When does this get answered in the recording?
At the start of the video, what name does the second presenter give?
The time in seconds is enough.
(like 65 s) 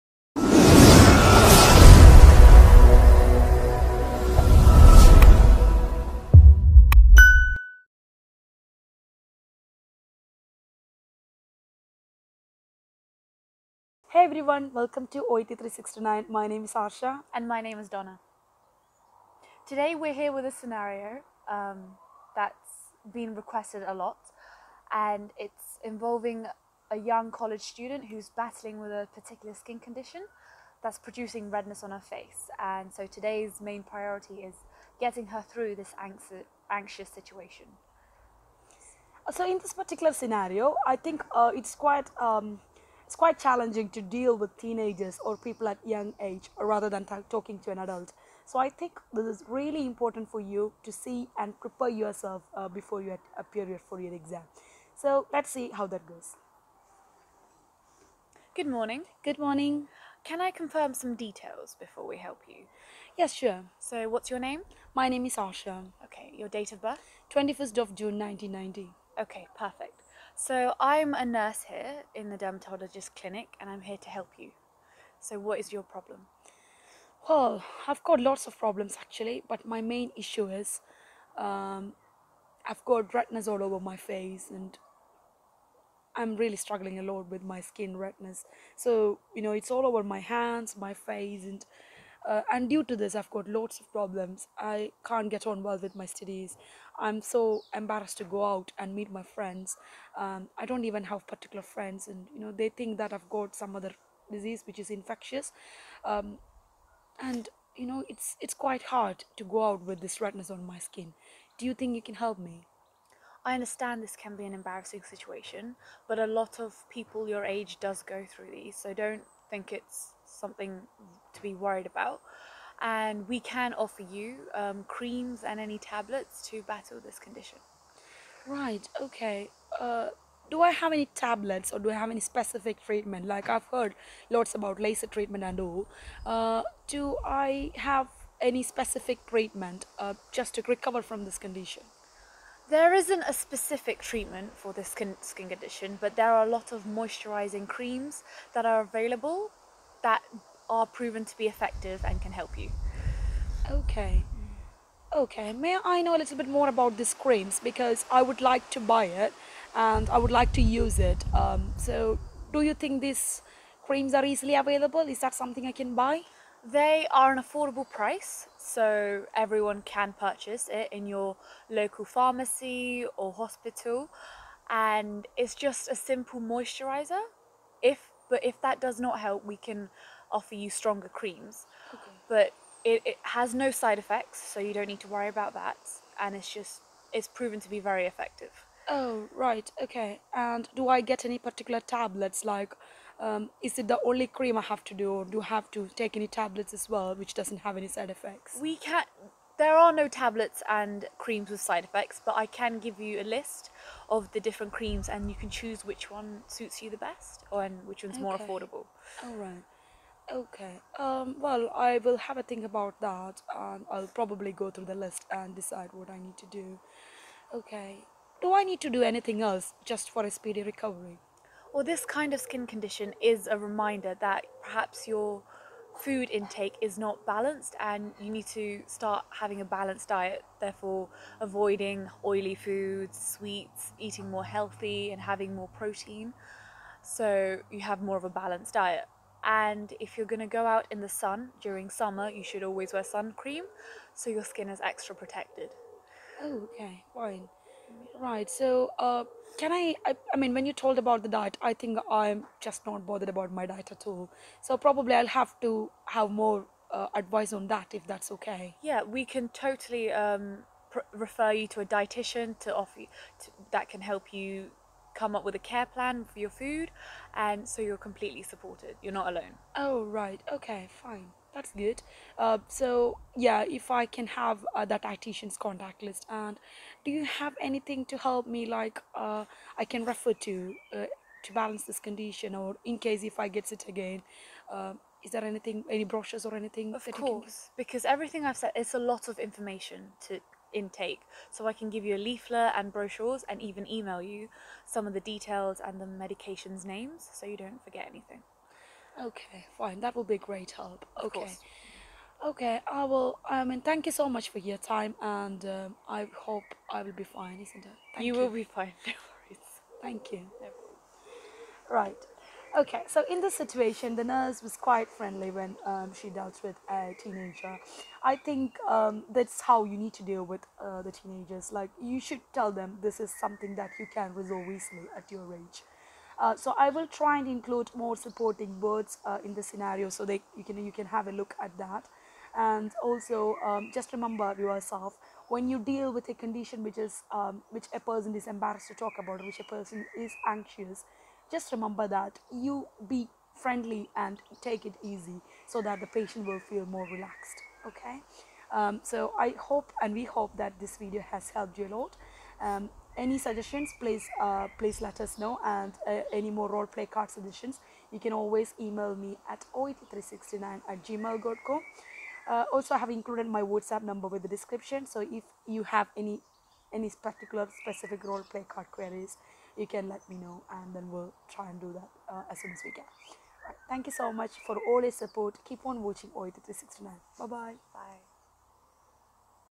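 17 s.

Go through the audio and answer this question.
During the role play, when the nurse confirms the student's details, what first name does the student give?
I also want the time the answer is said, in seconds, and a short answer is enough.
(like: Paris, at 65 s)
Asha, at 65 s.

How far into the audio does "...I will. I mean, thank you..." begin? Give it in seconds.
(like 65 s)
302 s.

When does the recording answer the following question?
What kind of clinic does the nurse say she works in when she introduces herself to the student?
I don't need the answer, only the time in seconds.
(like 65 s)
72 s.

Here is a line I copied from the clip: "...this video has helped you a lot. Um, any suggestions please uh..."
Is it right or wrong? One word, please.
right.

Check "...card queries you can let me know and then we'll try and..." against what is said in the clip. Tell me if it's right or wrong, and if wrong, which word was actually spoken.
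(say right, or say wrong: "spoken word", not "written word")
right.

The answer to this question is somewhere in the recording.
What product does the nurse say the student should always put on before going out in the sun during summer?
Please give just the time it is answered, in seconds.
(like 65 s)
243 s.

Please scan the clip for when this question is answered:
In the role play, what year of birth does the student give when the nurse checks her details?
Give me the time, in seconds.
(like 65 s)
68 s.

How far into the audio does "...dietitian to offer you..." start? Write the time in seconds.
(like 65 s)
261 s.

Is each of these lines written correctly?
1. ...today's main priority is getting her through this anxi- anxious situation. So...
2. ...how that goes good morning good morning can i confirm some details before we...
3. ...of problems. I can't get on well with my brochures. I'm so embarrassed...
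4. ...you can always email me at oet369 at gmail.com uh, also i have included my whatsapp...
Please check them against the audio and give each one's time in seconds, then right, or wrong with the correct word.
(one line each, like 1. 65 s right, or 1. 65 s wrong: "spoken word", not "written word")
1. 33 s right
2. 55 s right
3. 93 s wrong: "studies", not "brochures"
4. 358 s right.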